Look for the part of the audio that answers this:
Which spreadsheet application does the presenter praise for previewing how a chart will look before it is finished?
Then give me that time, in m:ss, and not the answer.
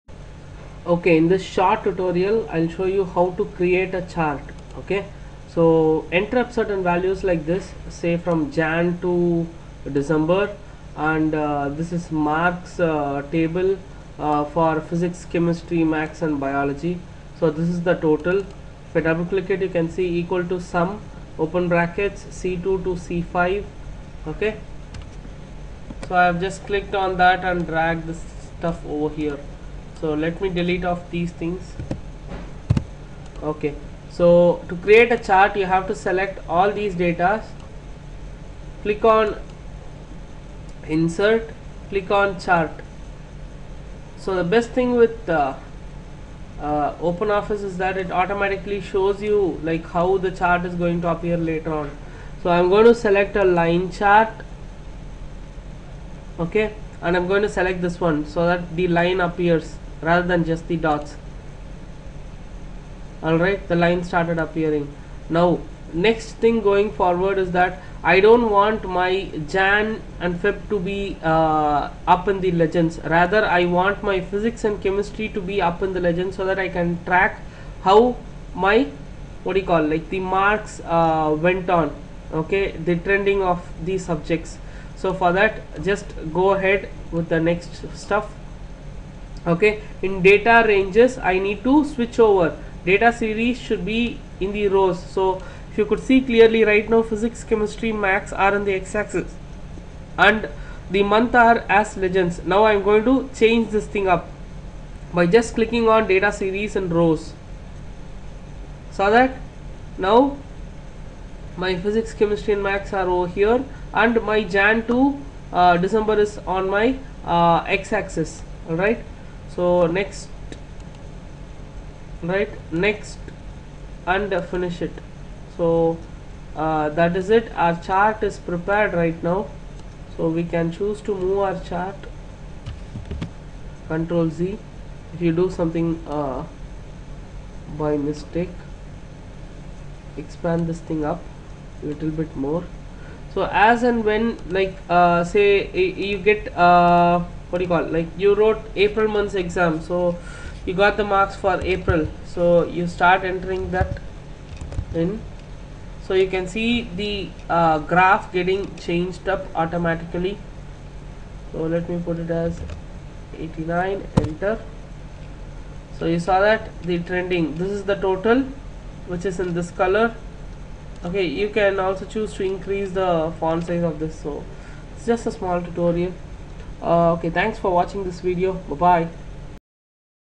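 0:46.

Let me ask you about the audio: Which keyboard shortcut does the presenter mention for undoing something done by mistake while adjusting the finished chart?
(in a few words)
Control Z.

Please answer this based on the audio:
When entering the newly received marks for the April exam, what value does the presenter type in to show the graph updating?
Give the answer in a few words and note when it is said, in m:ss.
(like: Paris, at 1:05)
89, at 2:43.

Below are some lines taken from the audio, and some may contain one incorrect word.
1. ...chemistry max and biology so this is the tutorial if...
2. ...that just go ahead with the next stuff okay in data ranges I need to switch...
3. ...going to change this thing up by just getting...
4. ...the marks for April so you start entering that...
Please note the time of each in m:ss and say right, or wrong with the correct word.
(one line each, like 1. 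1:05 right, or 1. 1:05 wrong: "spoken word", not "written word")
1. 0:15 wrong: "total", not "tutorial"
2. 1:25 right
3. 1:42 wrong: "clicking", not "getting"
4. 2:30 right.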